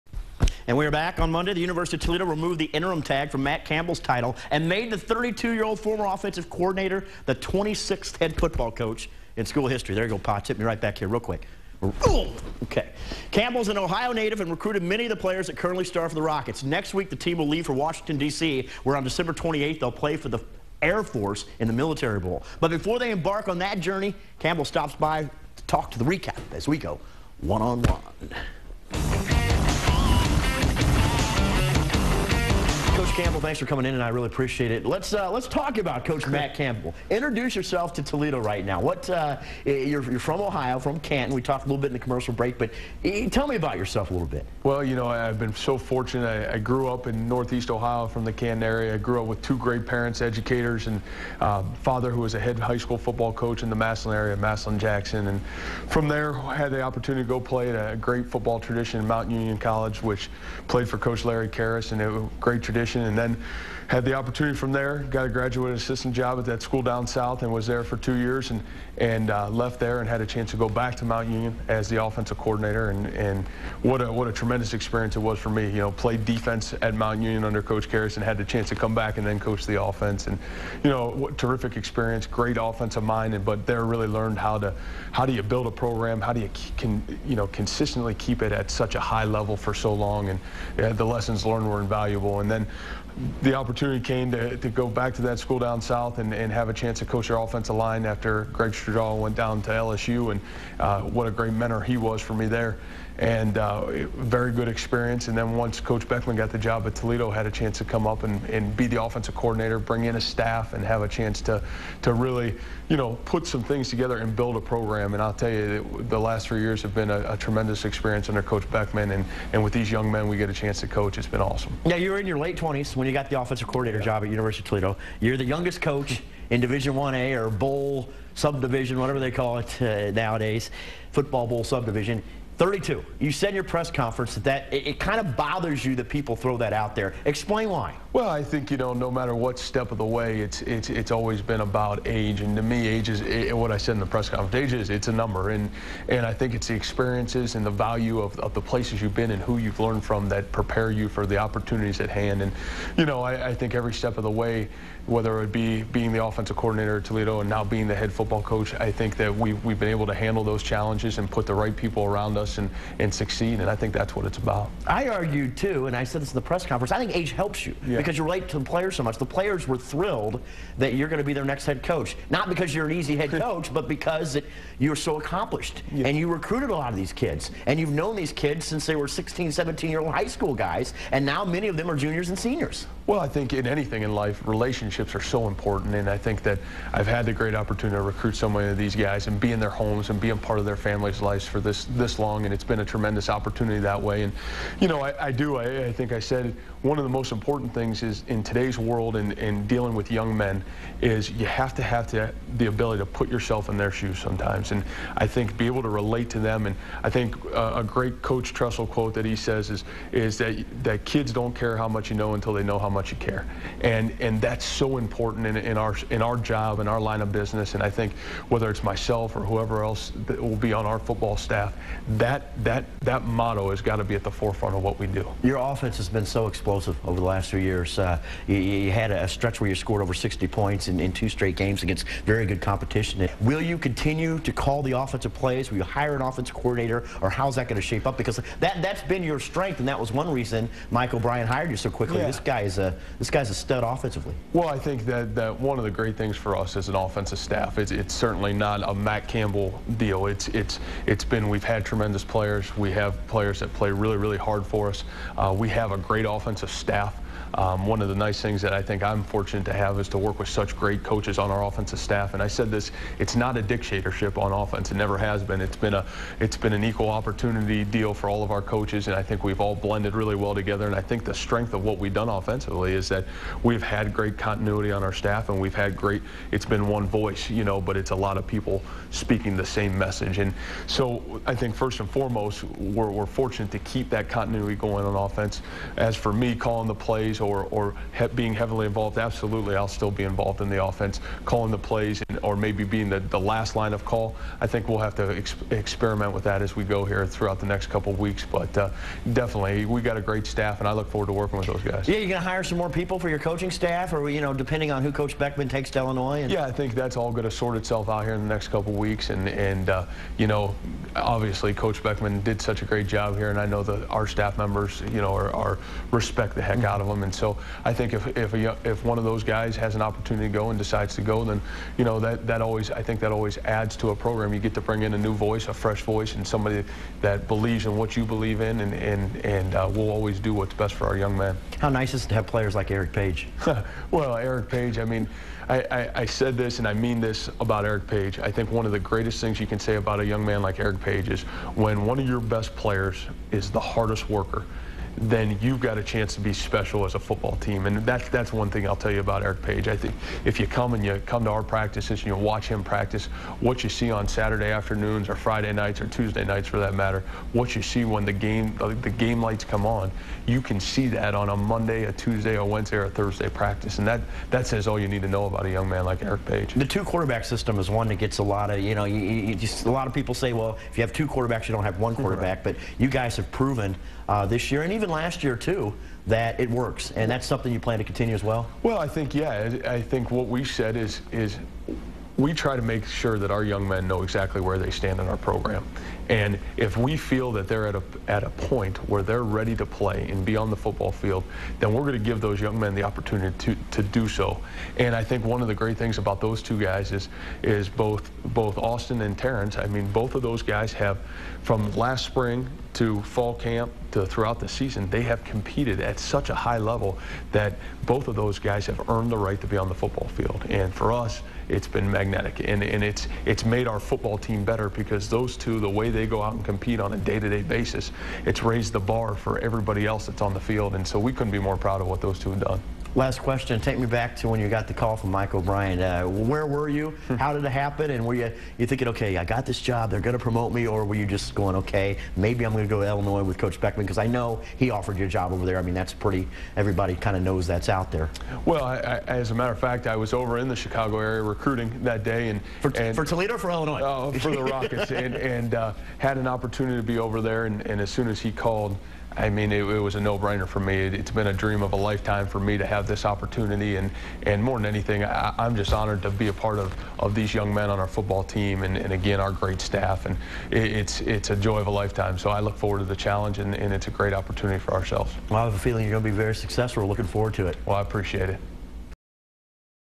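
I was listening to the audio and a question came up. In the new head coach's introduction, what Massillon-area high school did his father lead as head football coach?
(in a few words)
Massillon Jackson.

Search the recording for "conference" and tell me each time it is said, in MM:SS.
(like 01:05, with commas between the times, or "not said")
02:13, 02:24, 02:46.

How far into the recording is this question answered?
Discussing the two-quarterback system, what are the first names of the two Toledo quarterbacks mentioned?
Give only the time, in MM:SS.
06:38.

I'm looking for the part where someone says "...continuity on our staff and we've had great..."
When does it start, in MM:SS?
04:34.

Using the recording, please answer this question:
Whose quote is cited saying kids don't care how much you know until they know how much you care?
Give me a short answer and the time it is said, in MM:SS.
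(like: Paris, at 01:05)
Coach Tressel, at 03:28.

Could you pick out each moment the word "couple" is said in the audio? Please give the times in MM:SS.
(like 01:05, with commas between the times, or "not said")
04:57, 05:08.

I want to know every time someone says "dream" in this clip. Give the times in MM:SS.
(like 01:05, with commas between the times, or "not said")
07:31.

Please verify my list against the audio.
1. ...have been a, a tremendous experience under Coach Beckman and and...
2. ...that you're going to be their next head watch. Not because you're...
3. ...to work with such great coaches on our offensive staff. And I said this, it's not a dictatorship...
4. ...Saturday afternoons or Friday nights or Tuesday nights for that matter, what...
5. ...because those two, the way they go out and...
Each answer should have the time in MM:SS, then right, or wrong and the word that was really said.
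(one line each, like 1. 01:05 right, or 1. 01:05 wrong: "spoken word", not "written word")
1. 01:56 right
2. 02:50 wrong: "coach", not "watch"
3. 04:20 right
4. 05:54 right
5. 06:54 right.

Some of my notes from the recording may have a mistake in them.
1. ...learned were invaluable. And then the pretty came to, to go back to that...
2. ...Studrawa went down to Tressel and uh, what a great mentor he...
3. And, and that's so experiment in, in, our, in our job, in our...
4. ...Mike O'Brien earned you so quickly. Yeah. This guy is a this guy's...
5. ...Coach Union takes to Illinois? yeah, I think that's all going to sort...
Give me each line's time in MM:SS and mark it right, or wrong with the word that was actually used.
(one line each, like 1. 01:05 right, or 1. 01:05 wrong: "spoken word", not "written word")
1. 01:31 wrong: "opportunity", not "pretty"
2. 01:38 wrong: "LSU", not "Tressel"
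3. 03:33 wrong: "important", not "experiment"
4. 04:00 wrong: "hired", not "earned"
5. 05:05 wrong: "Beckman", not "Union".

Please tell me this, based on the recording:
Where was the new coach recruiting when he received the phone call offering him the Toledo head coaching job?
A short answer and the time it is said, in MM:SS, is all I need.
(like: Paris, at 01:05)
Chicago area, at 07:20.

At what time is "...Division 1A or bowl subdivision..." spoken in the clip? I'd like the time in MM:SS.
02:06.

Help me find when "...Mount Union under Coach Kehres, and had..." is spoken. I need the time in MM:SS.
01:16.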